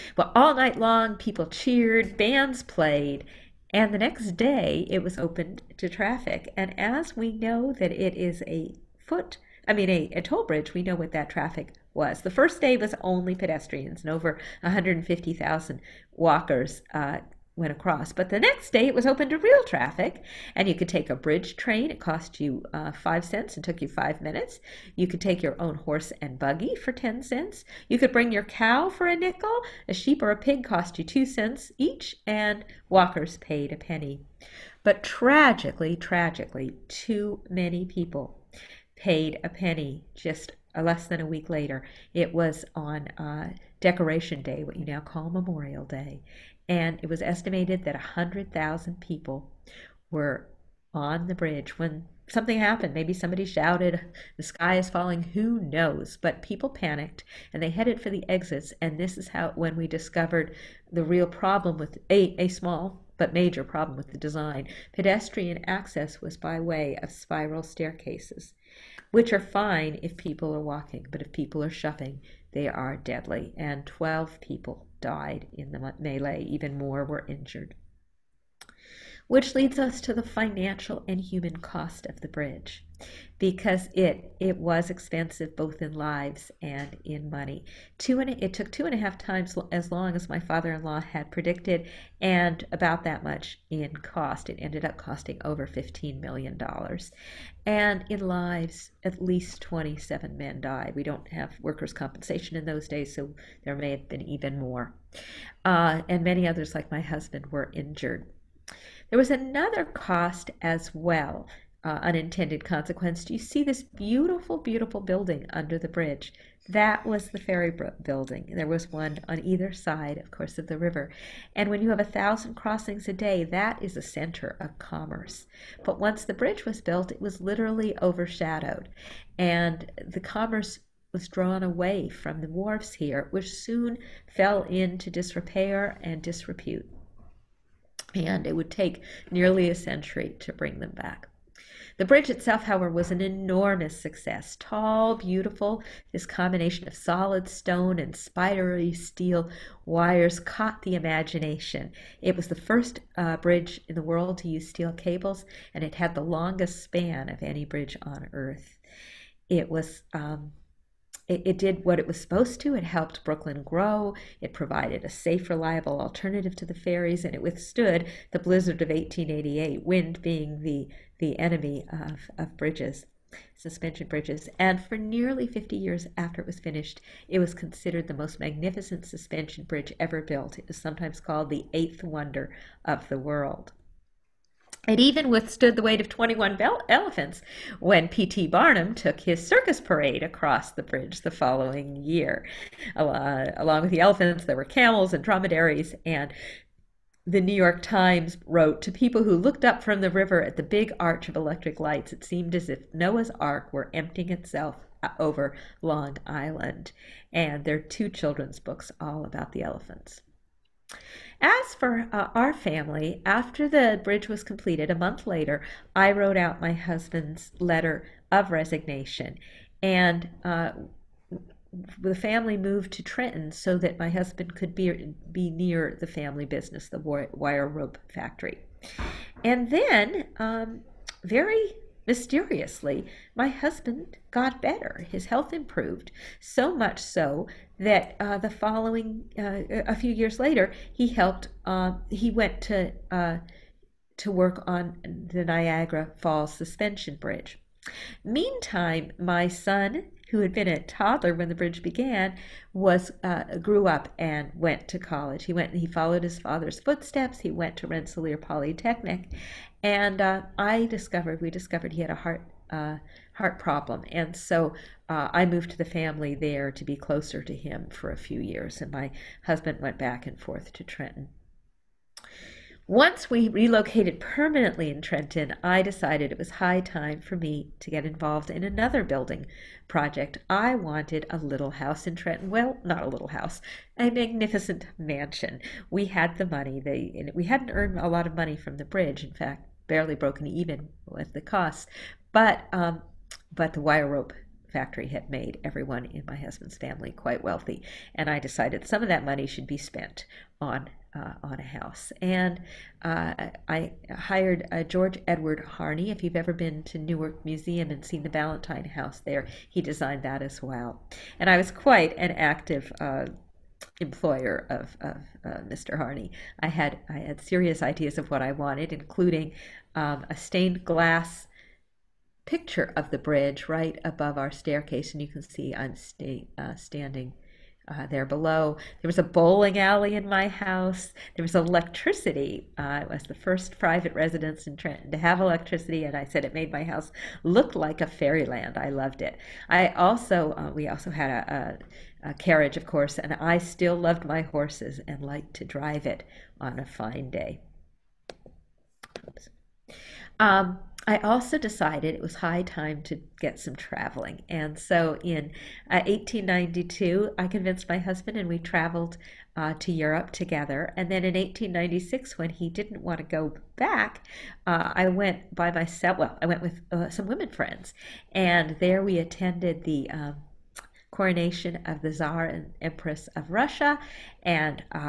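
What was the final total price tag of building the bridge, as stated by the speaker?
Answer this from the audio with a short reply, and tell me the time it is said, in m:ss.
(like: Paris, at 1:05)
over $15 million, at 1:35.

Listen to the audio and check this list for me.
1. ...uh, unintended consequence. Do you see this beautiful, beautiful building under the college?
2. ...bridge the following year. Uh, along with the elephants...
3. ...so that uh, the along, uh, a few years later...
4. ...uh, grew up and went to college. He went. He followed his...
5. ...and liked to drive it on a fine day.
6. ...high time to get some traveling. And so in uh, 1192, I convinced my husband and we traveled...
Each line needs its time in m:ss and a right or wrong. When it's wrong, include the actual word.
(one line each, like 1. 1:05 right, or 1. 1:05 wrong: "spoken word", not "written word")
1. 1:51 wrong: "bridge", not "college"
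2. 3:10 right
3. 3:56 wrong: "following", not "along"
4. 4:13 right
5. 5:45 right
6. 5:52 wrong: "1892", not "1192".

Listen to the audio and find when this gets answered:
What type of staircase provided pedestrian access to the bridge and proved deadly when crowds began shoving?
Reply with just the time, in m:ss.
1:07.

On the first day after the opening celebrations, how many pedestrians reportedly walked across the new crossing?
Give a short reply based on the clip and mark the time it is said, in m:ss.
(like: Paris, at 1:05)
over 150,000, at 0:14.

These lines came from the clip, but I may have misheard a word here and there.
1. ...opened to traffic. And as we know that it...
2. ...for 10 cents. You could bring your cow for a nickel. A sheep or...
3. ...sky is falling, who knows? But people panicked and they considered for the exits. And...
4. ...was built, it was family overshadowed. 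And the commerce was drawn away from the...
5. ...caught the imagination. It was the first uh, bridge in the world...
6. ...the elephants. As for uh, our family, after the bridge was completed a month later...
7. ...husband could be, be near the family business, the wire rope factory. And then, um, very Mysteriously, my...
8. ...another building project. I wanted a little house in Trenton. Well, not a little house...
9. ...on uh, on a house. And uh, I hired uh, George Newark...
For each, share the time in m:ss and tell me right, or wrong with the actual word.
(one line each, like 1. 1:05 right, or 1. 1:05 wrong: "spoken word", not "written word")
1. 0:05 right
2. 0:26 right
3. 0:54 wrong: "headed", not "considered"
4. 2:06 wrong: "literally", not "family"
5. 2:30 right
6. 3:29 right
7. 3:44 right
8. 4:38 right
9. 5:00 wrong: "Edward", not "Newark".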